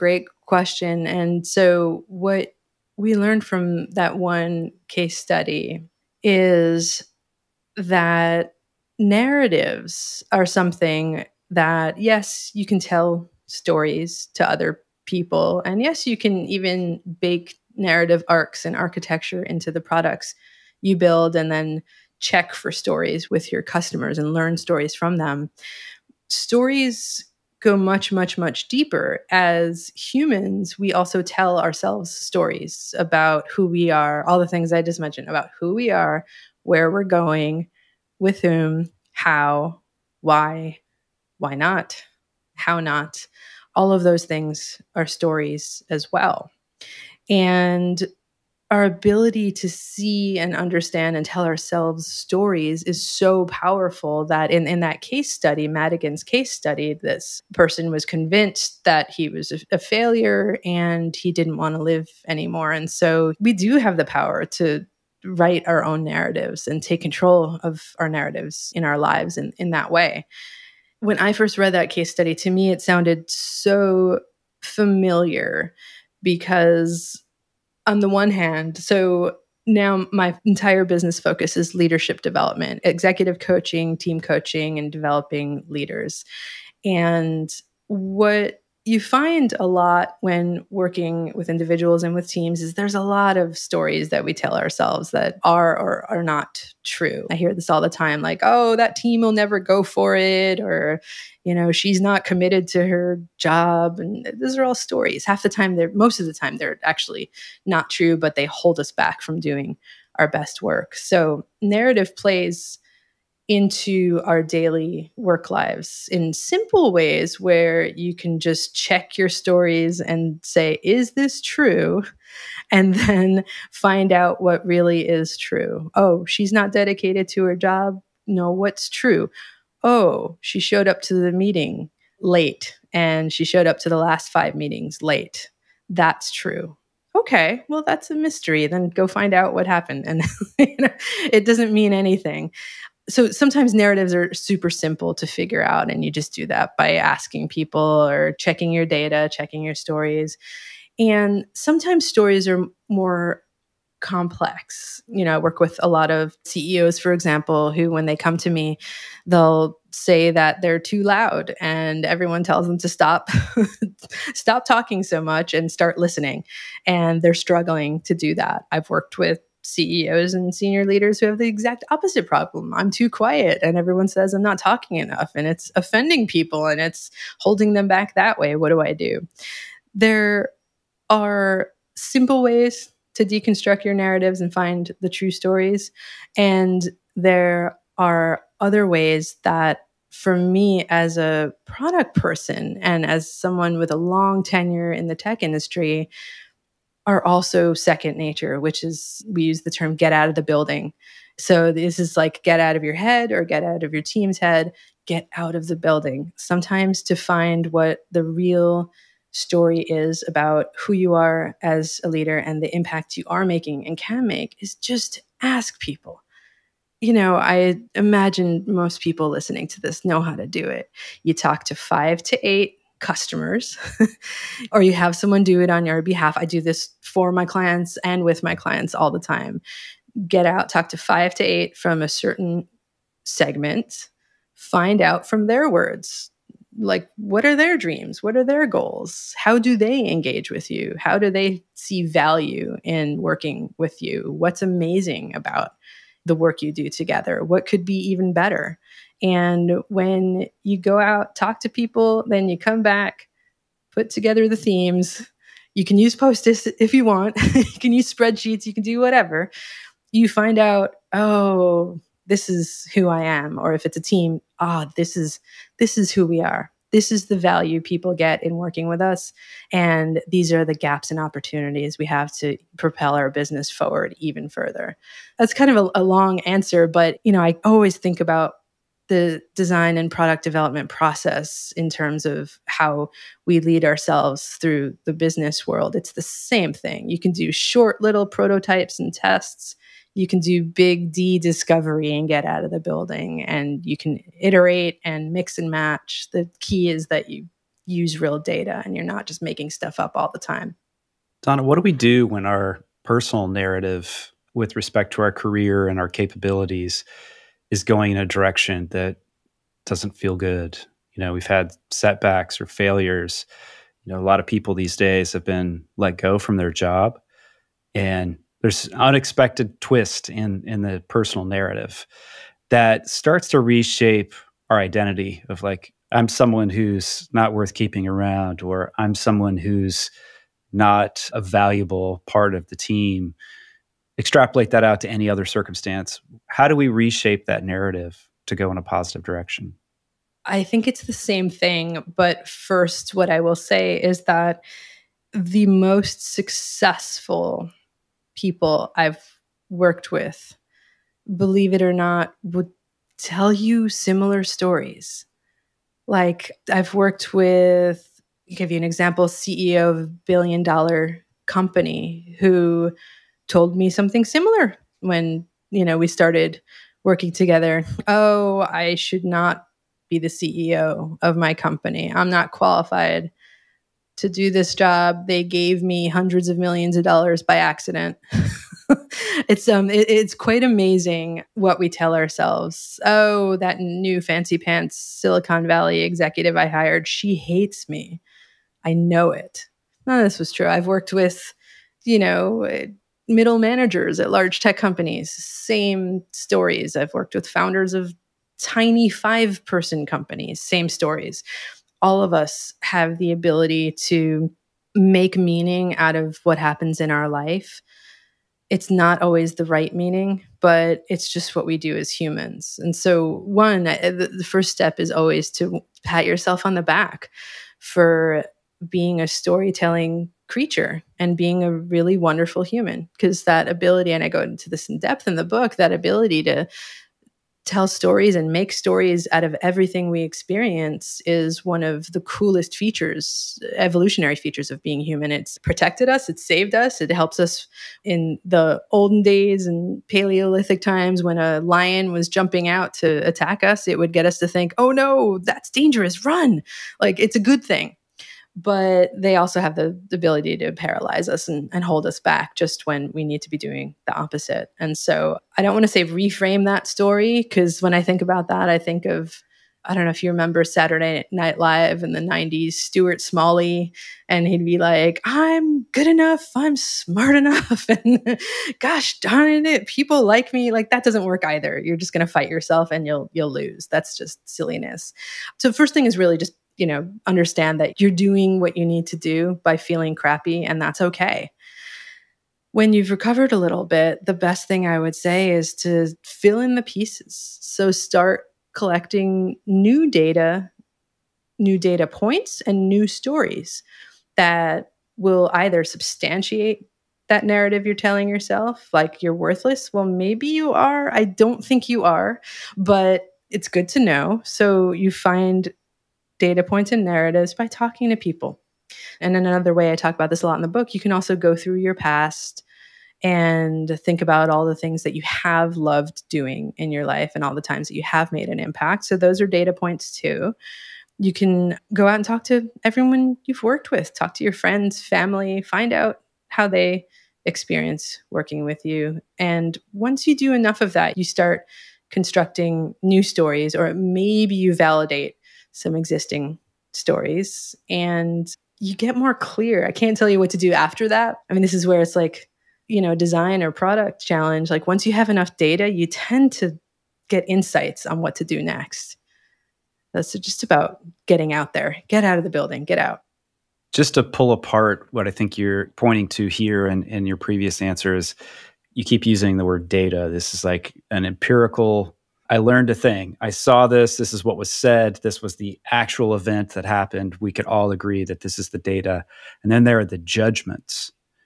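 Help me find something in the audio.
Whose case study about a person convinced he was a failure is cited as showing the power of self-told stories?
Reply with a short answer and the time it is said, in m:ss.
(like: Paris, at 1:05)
Madigan, at 0:55.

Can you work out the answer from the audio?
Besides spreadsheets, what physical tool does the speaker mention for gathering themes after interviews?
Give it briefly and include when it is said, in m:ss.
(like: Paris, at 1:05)
post its, at 4:16.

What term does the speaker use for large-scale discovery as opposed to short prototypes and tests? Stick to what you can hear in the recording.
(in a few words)
big D discovery.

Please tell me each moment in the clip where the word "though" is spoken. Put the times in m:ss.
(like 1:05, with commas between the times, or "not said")
not said.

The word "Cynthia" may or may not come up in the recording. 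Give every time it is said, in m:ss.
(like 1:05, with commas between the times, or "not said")
not said.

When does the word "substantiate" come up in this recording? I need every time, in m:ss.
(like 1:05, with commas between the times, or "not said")
8:15.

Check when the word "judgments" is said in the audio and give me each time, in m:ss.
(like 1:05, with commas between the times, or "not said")
9:30.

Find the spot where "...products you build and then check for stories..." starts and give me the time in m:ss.
0:19.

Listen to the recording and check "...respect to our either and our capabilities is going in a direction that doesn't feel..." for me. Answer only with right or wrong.
wrong.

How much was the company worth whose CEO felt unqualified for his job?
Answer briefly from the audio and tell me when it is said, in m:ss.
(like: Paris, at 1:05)
billion dollar, at 6:00.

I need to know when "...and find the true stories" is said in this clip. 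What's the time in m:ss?
3:04.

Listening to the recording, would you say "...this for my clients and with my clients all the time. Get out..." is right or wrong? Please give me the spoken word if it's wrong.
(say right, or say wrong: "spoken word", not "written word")
right.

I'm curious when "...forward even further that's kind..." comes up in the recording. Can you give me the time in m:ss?
4:33.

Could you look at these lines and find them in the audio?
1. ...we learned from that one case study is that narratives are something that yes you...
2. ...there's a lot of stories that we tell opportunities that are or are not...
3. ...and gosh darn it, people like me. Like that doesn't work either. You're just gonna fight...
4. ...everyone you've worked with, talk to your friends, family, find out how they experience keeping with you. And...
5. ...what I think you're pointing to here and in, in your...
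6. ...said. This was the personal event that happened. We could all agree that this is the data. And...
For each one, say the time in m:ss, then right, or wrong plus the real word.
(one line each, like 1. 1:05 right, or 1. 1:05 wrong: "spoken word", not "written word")
1. 0:02 right
2. 1:32 wrong: "ourselves", not "opportunities"
3. 7:47 right
4. 8:42 wrong: "working", not "keeping"
5. 9:15 right
6. 9:24 wrong: "actual", not "personal".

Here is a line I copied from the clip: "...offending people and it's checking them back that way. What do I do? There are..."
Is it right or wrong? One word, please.
wrong.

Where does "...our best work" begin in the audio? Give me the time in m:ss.
1:50.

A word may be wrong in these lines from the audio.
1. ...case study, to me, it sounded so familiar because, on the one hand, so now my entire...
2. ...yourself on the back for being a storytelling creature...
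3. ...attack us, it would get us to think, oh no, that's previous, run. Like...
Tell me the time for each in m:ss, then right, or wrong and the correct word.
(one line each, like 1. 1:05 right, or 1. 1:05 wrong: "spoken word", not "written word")
1. 1:11 right
2. 6:56 right
3. 7:23 wrong: "dangerous", not "previous".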